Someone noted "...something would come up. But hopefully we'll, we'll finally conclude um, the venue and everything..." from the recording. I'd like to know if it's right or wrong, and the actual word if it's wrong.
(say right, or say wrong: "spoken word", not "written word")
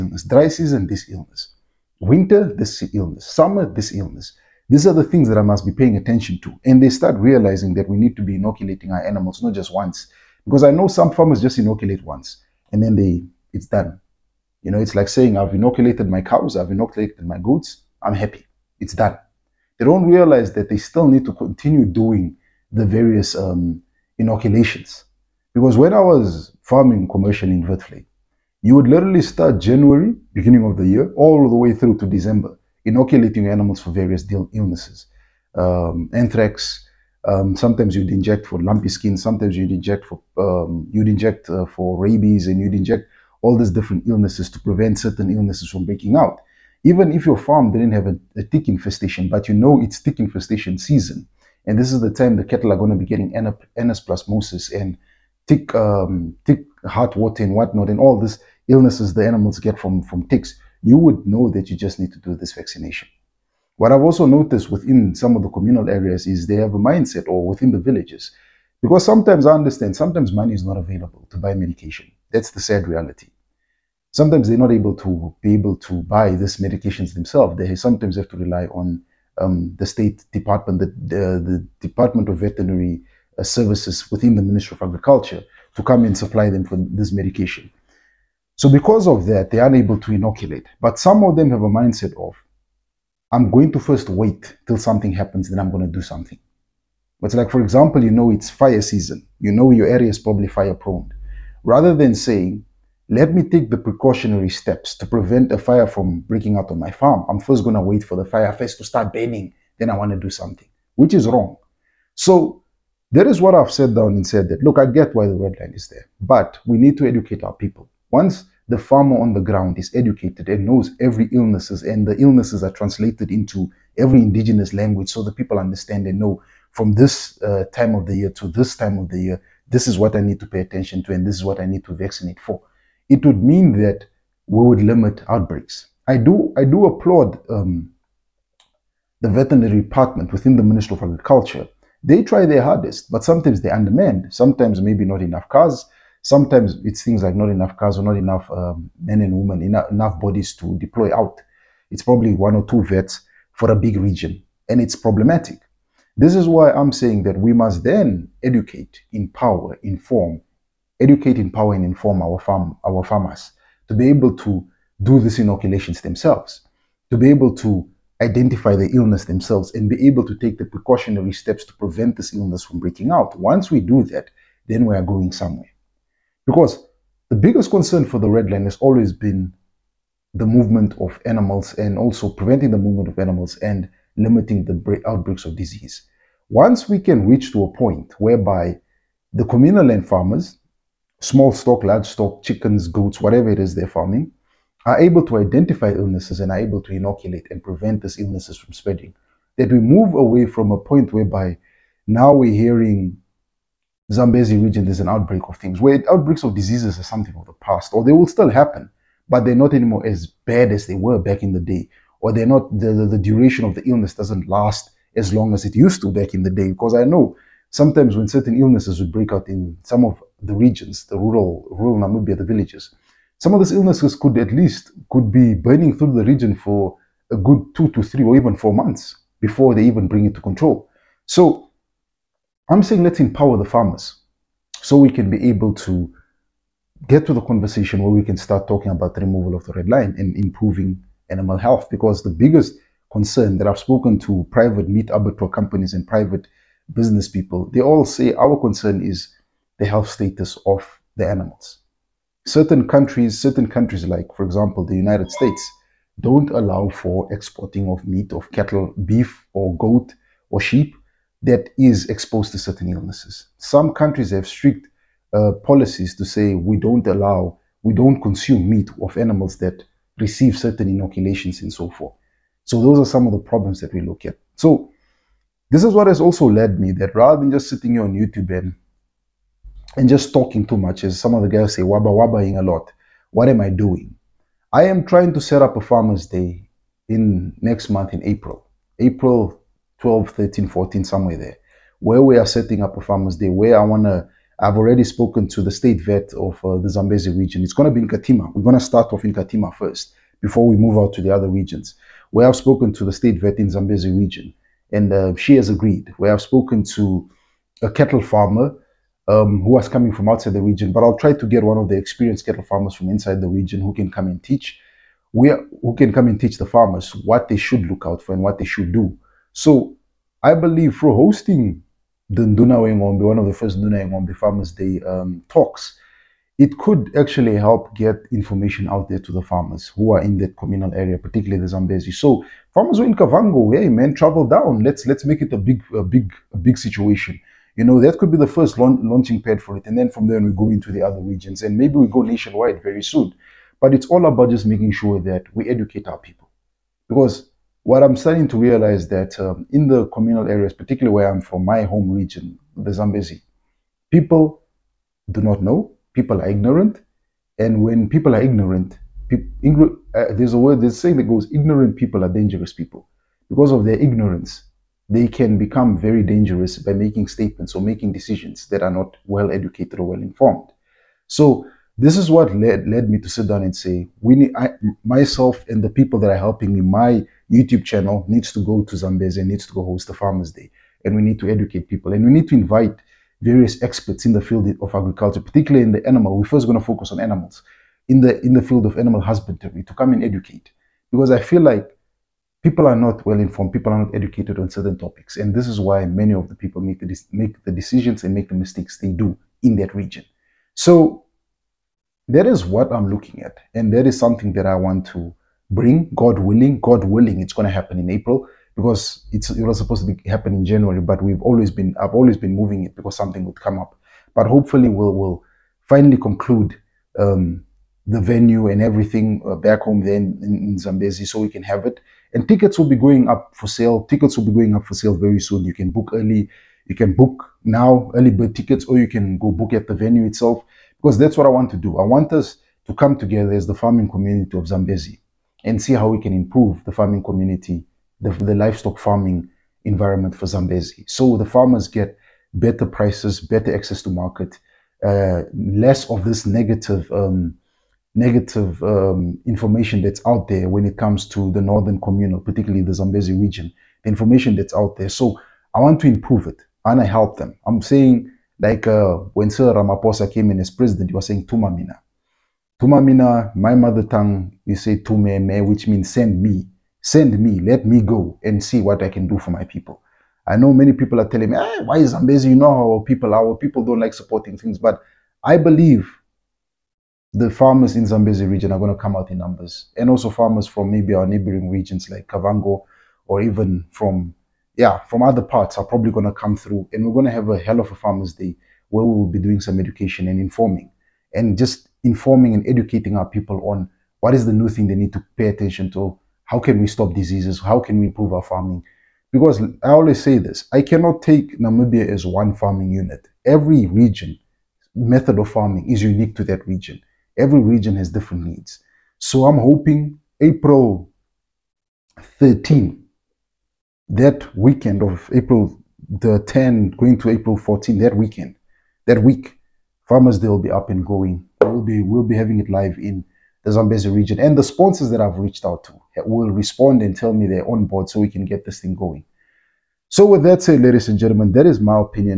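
right.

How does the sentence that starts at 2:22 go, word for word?
They try their hardest, but sometimes they undermanned.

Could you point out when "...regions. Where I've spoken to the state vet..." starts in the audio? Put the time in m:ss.
5:01.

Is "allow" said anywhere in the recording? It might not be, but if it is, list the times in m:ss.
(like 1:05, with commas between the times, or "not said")
4:16, 4:27.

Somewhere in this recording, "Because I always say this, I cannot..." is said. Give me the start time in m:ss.
8:19.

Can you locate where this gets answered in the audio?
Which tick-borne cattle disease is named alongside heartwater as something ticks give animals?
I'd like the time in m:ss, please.
0:53.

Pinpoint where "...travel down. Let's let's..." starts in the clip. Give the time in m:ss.
5:34.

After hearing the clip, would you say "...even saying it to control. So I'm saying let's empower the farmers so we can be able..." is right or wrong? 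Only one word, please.
wrong.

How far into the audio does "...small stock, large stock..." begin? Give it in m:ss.
3:11.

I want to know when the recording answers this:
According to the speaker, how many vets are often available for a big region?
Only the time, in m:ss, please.
2:32.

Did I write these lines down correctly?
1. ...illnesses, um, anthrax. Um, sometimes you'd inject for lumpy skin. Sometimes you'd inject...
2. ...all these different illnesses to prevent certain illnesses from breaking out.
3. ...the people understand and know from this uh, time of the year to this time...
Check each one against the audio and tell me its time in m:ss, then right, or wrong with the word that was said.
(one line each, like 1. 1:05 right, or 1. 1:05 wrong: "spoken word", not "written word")
1. 0:34 right
2. 0:43 right
3. 2:05 right.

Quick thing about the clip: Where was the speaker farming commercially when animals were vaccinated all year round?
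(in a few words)
Vertley.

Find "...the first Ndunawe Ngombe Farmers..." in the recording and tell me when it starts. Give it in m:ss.
5:23.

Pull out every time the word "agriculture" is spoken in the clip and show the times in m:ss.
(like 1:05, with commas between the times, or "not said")
1:24, 2:21, 6:24.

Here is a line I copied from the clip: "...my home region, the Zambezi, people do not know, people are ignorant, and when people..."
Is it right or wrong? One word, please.
right.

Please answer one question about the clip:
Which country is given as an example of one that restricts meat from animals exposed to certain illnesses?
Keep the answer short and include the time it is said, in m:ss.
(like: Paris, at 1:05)
United States, at 4:14.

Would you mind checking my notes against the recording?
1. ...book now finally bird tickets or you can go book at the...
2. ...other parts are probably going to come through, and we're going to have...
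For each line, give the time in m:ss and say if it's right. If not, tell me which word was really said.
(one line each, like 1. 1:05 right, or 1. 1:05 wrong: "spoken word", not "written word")
1. 7:07 wrong: "early", not "finally"
2. 8:05 right.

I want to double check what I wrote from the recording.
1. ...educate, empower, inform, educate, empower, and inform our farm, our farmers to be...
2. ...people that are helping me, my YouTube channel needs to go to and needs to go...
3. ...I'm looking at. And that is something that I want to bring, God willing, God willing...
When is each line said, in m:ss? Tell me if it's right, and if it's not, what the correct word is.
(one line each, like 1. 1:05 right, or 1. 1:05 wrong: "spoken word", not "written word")
1. 2:38 right
2. 6:15 right
3. 6:42 right.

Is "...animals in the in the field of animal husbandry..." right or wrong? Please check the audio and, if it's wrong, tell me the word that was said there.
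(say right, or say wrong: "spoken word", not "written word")
right.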